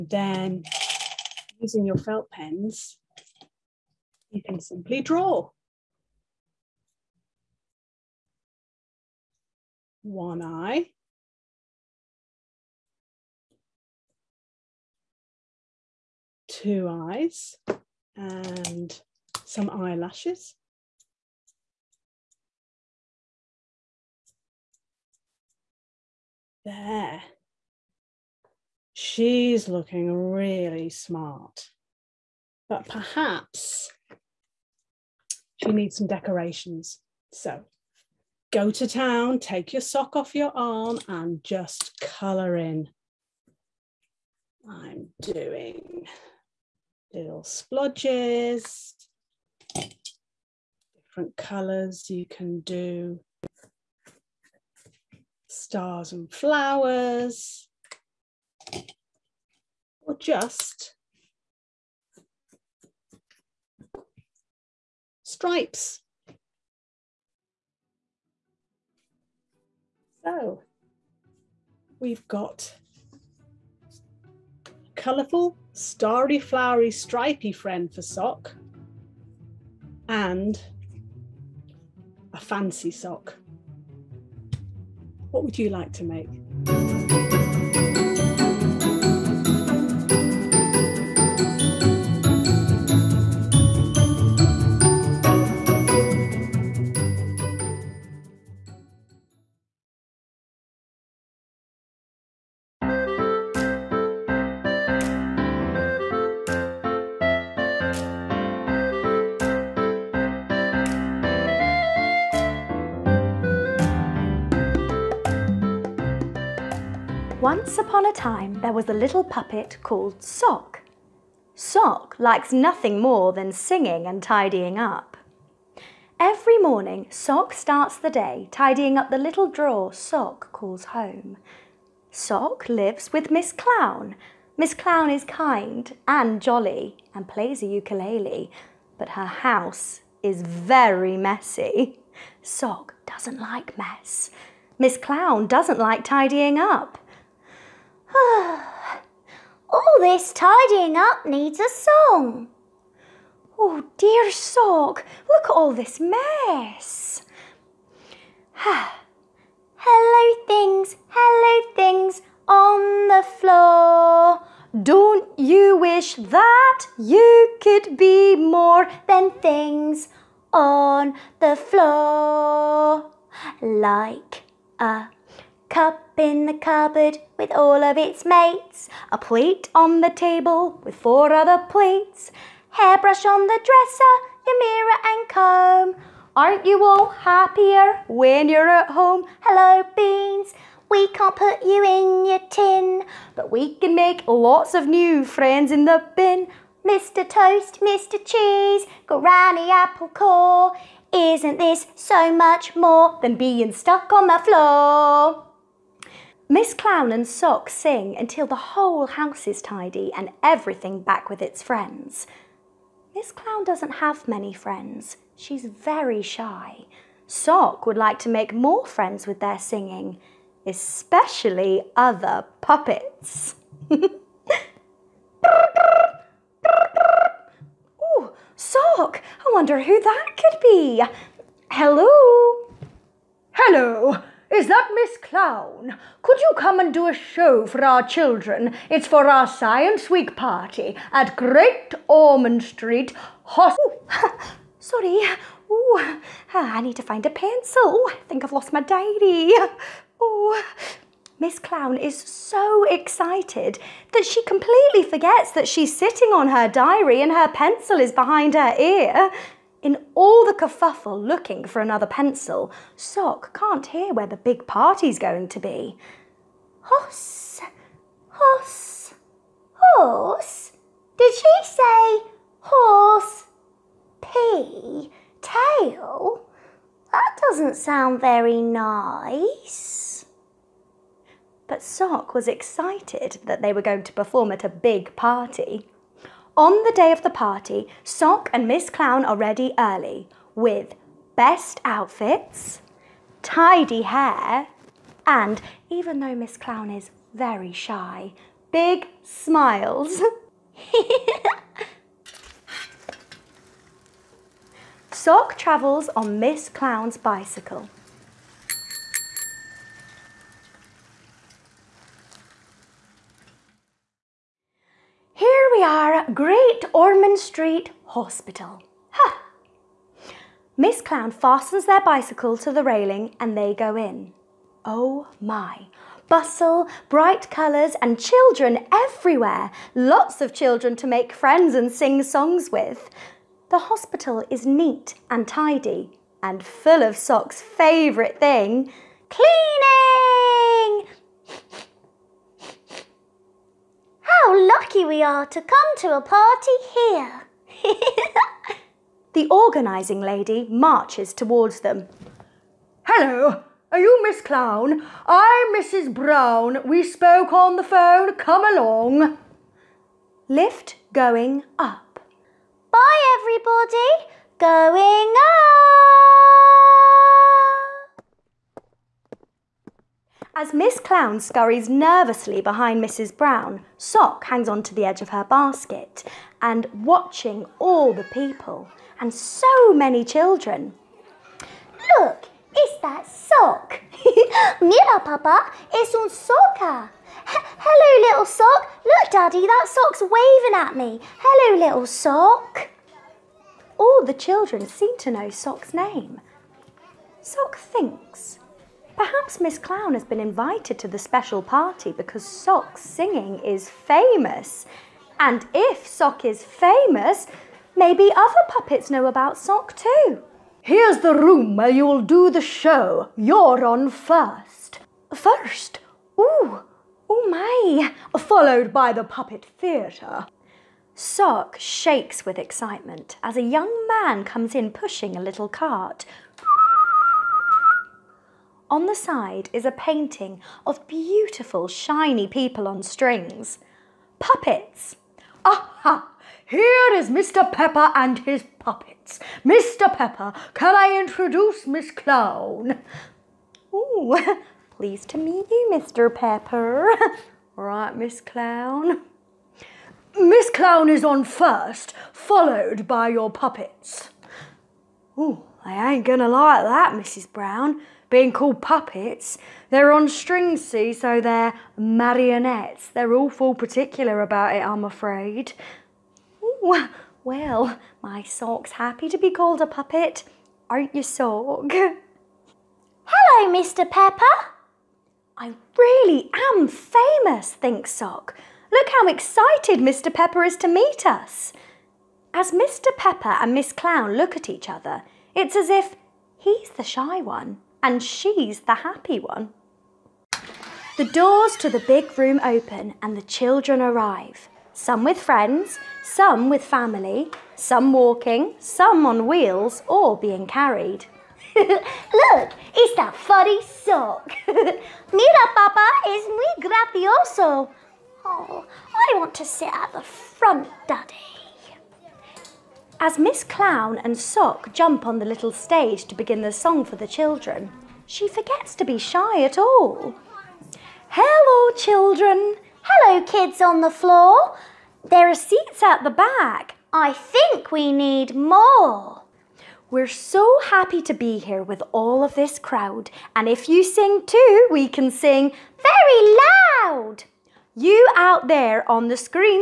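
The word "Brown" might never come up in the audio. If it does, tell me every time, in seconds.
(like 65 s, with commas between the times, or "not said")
356 s, 373 s, 457 s.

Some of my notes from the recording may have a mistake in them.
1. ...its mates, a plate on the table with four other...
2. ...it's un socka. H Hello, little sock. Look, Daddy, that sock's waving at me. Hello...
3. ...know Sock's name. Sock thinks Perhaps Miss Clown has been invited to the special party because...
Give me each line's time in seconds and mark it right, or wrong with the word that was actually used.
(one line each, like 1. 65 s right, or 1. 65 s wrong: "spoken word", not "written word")
1. 177 s right
2. 385 s right
3. 395 s right.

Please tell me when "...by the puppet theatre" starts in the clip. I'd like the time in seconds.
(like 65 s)
418 s.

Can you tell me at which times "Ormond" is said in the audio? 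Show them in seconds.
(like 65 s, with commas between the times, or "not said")
242 s, 316 s.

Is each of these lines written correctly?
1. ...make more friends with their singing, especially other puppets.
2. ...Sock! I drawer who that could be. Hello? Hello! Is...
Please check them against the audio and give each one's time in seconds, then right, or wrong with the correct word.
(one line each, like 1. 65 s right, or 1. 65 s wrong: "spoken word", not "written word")
1. 218 s right
2. 228 s wrong: "wonder", not "drawer".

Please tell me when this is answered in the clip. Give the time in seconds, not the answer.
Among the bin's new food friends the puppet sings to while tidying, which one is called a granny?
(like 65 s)
199 s.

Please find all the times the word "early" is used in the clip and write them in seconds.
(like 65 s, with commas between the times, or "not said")
289 s.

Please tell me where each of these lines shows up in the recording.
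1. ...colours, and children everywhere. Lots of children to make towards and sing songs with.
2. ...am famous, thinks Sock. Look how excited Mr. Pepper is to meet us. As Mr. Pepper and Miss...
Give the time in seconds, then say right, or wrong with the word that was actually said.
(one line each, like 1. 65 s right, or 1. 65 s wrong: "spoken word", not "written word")
1. 327 s wrong: "friends", not "towards"
2. 476 s right.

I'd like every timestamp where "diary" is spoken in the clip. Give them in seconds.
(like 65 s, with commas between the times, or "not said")
248 s, 256 s.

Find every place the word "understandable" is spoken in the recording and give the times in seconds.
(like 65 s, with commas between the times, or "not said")
not said.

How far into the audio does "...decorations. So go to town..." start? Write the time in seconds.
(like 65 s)
36 s.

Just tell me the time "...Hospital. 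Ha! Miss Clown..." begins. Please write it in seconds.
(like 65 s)
318 s.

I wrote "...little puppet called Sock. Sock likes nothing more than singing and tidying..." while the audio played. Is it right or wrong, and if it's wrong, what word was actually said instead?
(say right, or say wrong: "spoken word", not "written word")
right.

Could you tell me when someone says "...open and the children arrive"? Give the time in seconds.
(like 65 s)
492 s.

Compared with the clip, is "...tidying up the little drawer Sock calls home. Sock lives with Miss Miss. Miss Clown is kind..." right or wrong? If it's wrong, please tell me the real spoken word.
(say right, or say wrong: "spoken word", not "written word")
wrong: "Clown", not "Miss".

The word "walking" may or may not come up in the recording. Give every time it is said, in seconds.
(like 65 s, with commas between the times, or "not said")
498 s.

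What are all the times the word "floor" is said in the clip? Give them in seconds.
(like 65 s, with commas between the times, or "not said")
163 s, 171 s, 204 s, 524 s.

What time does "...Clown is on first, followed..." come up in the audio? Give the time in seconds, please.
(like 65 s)
450 s.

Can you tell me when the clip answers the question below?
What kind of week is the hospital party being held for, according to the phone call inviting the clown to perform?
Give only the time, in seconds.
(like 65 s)
239 s.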